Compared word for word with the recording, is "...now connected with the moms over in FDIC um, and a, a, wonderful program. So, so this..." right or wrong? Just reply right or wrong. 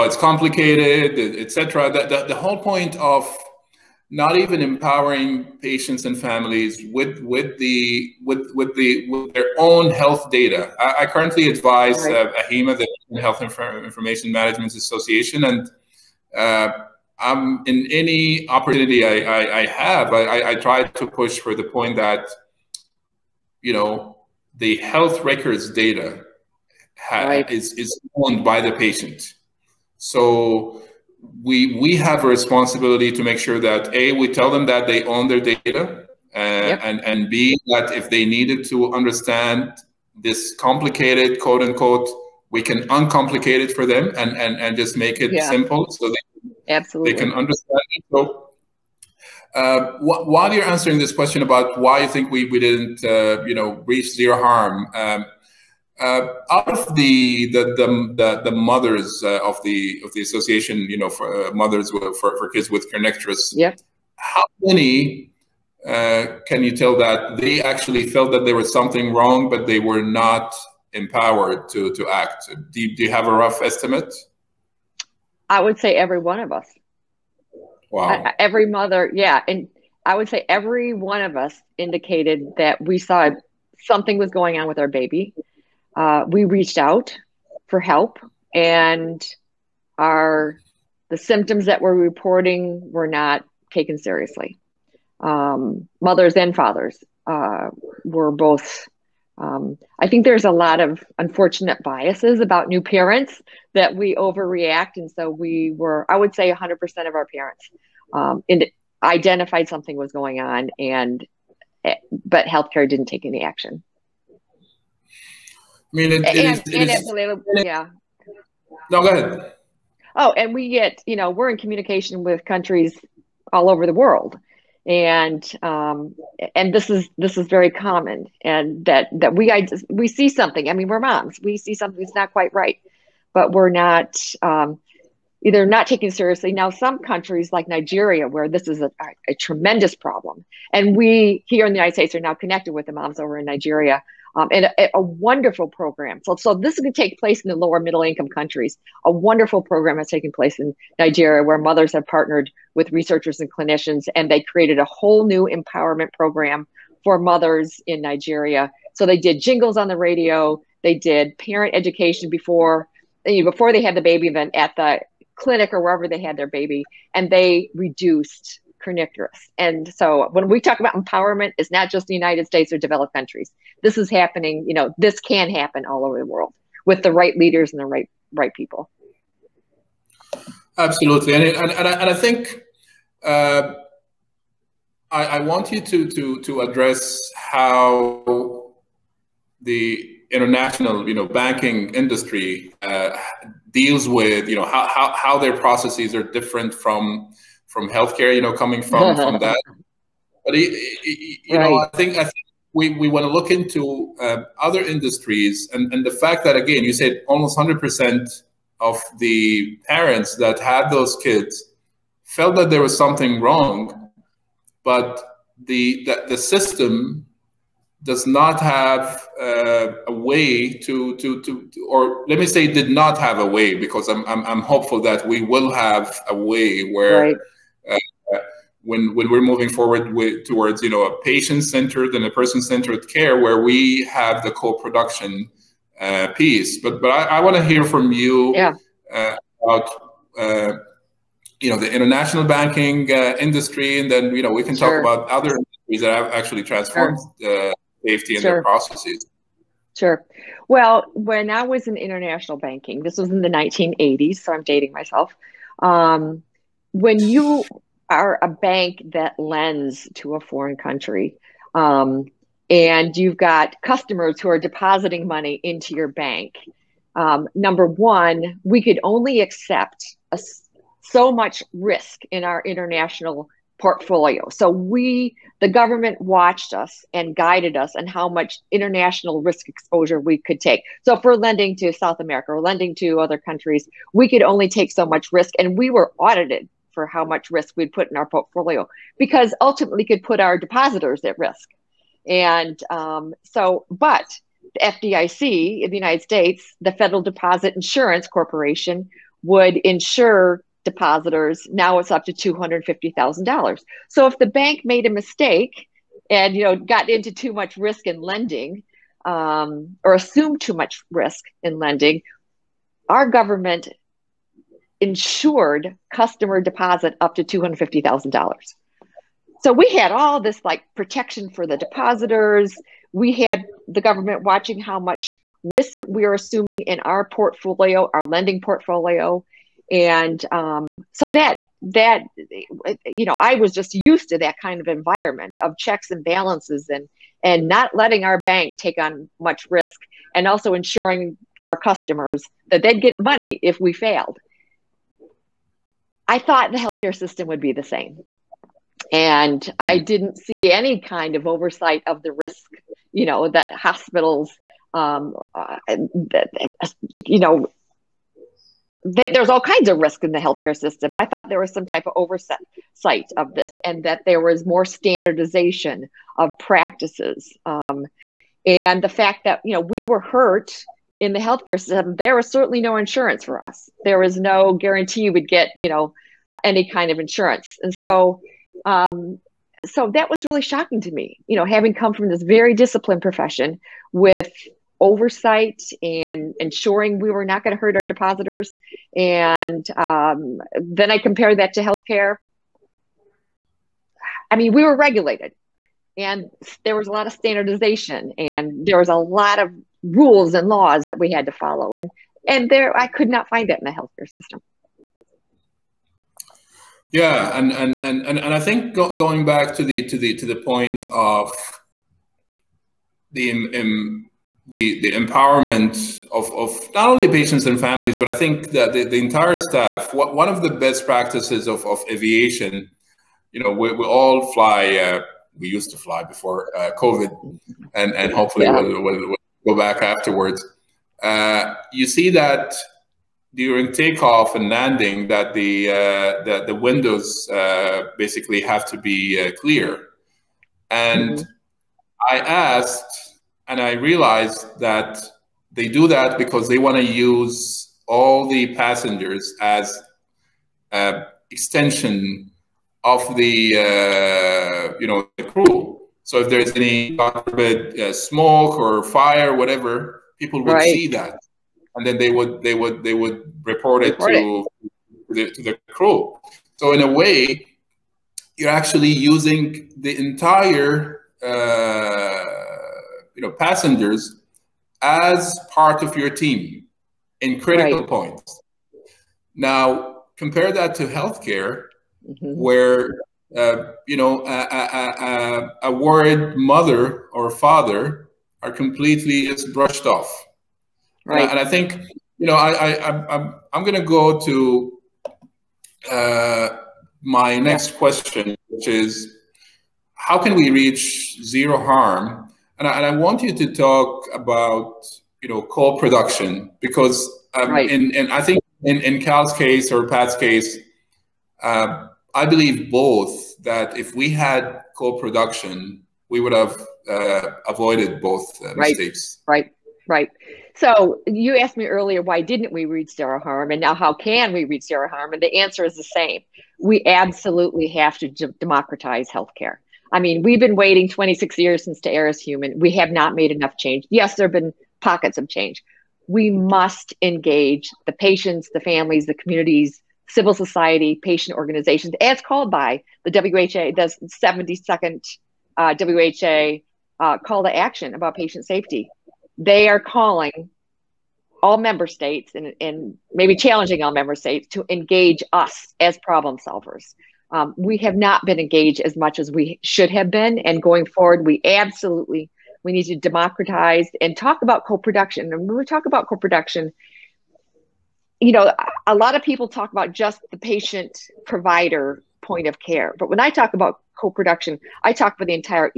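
wrong.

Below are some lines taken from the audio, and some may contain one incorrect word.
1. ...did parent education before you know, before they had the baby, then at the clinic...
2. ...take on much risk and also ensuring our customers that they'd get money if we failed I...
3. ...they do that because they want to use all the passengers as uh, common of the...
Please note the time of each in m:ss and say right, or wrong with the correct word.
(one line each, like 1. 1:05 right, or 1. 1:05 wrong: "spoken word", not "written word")
1. 2:40 right
2. 5:38 right
3. 7:25 wrong: "extension", not "common".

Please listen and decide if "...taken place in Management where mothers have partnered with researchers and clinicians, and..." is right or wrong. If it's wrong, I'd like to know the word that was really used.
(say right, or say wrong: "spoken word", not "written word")
wrong: "Nigeria", not "Management".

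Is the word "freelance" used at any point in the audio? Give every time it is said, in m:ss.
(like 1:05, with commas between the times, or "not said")
not said.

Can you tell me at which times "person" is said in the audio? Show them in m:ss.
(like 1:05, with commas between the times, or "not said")
3:52.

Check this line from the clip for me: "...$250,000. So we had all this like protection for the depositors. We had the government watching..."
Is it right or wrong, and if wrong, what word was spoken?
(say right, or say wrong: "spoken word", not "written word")
right.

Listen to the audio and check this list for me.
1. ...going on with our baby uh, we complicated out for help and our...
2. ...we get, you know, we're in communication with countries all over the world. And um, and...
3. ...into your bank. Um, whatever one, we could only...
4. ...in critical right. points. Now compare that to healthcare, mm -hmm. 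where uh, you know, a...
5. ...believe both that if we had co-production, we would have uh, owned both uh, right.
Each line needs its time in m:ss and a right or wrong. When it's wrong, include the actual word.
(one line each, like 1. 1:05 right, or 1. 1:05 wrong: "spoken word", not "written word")
1. 1:24 wrong: "reached", not "complicated"
2. 2:00 right
3. 4:25 wrong: "number", not "whatever"
4. 7:57 right
5. 8:32 wrong: "avoided", not "owned".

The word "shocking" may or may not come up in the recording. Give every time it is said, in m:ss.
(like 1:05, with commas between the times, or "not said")
6:20.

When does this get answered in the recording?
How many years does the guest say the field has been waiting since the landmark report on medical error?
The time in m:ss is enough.
8:51.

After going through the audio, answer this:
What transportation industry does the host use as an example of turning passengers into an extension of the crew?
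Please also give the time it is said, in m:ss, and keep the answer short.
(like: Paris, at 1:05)
aviation, at 7:02.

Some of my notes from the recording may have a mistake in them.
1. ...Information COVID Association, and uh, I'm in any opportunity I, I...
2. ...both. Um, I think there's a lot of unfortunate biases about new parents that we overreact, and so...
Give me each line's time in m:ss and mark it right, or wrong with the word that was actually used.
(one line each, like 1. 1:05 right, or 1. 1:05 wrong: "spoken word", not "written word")
1. 0:13 wrong: "Management", not "COVID"
2. 1:38 right.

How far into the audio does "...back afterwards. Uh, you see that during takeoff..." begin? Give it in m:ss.
7:09.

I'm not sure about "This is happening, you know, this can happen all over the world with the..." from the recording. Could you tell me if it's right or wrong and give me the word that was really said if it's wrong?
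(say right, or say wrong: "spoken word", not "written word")
right.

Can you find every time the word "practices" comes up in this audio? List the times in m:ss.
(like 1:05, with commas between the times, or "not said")
6:06, 7:01.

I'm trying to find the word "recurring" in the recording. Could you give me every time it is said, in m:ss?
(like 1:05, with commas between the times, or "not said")
not said.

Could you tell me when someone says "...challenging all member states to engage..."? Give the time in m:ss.
9:13.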